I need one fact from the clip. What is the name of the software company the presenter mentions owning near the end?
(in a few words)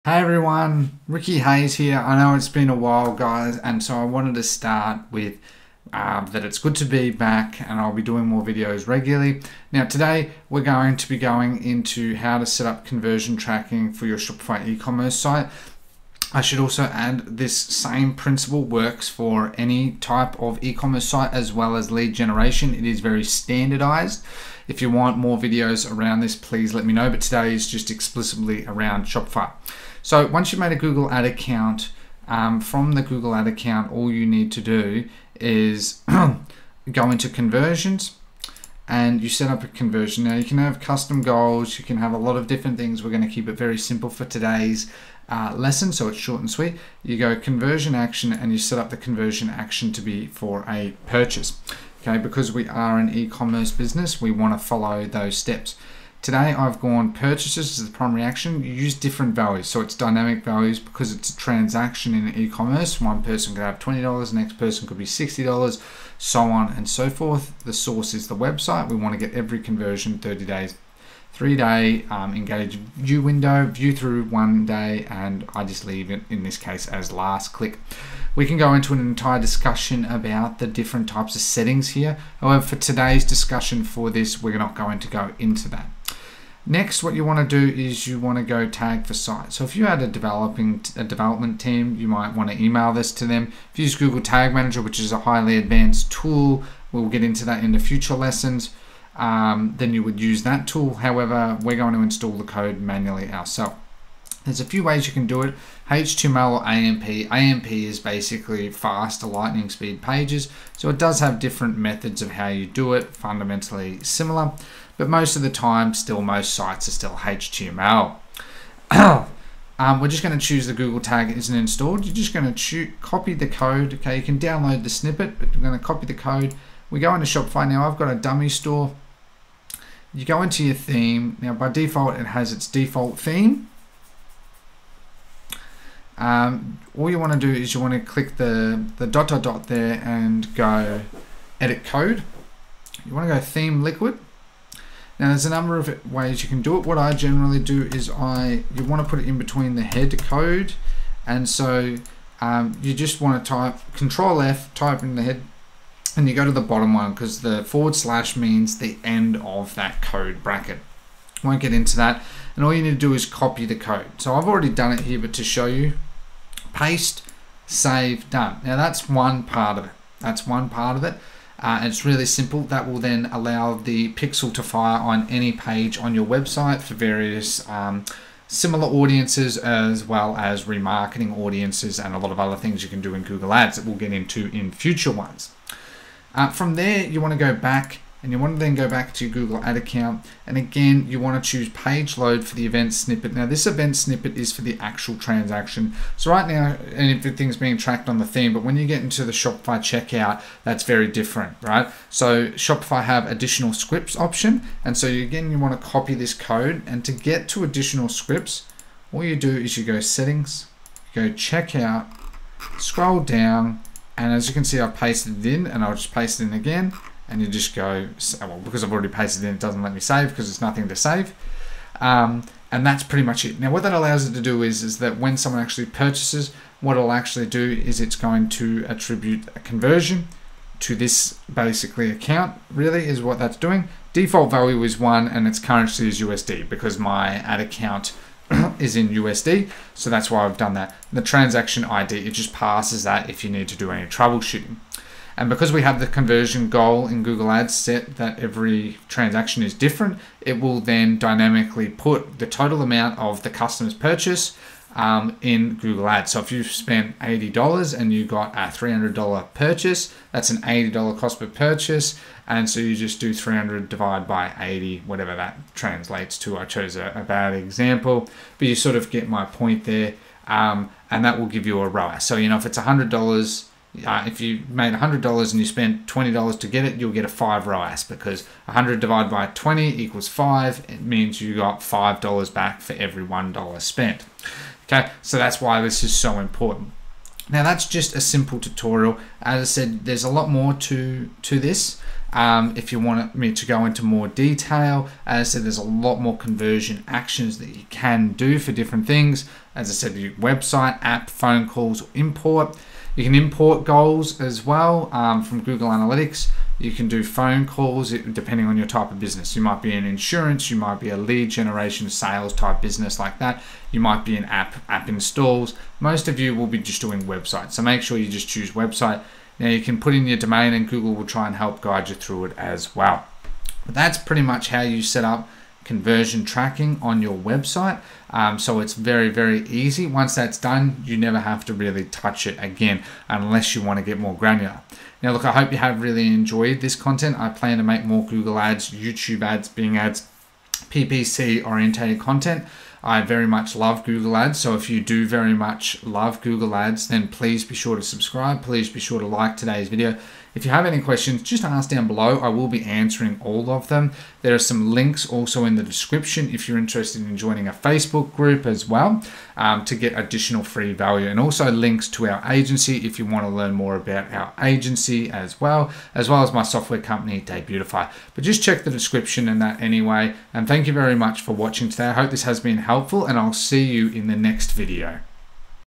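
Debutify.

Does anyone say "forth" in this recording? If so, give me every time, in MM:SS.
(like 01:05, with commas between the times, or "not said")
01:07.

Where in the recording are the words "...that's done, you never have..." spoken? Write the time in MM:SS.
05:30.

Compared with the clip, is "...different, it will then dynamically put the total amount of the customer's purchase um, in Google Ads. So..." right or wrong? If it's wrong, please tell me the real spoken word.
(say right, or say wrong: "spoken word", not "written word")
right.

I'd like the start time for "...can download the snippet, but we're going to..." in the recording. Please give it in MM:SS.
02:04.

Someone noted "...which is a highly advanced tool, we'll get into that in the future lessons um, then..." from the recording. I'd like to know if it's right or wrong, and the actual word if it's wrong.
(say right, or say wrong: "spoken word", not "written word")
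right.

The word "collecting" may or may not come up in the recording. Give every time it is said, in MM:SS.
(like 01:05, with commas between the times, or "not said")
not said.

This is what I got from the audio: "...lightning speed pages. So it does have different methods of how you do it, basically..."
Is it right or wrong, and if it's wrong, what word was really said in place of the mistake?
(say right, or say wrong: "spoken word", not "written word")
wrong: "fundamentally", not "basically".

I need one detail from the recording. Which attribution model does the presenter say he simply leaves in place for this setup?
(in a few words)
Last click.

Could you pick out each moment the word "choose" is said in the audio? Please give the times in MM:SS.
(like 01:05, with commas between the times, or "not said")
02:00, 03:11, 05:18.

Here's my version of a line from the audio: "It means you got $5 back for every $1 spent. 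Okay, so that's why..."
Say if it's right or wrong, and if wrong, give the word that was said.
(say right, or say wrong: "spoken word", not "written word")
right.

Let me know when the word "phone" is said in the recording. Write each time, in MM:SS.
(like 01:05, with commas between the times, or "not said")
05:01, 05:07.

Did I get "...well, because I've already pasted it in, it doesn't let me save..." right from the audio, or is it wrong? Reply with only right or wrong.
right.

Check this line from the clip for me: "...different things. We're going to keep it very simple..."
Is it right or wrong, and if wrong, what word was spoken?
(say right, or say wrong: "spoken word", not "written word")
right.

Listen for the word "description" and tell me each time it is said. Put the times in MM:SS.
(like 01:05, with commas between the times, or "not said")
05:55, 06:08.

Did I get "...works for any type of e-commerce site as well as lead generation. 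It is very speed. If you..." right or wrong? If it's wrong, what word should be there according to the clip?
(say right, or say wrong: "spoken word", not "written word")
wrong: "standardized", not "speed".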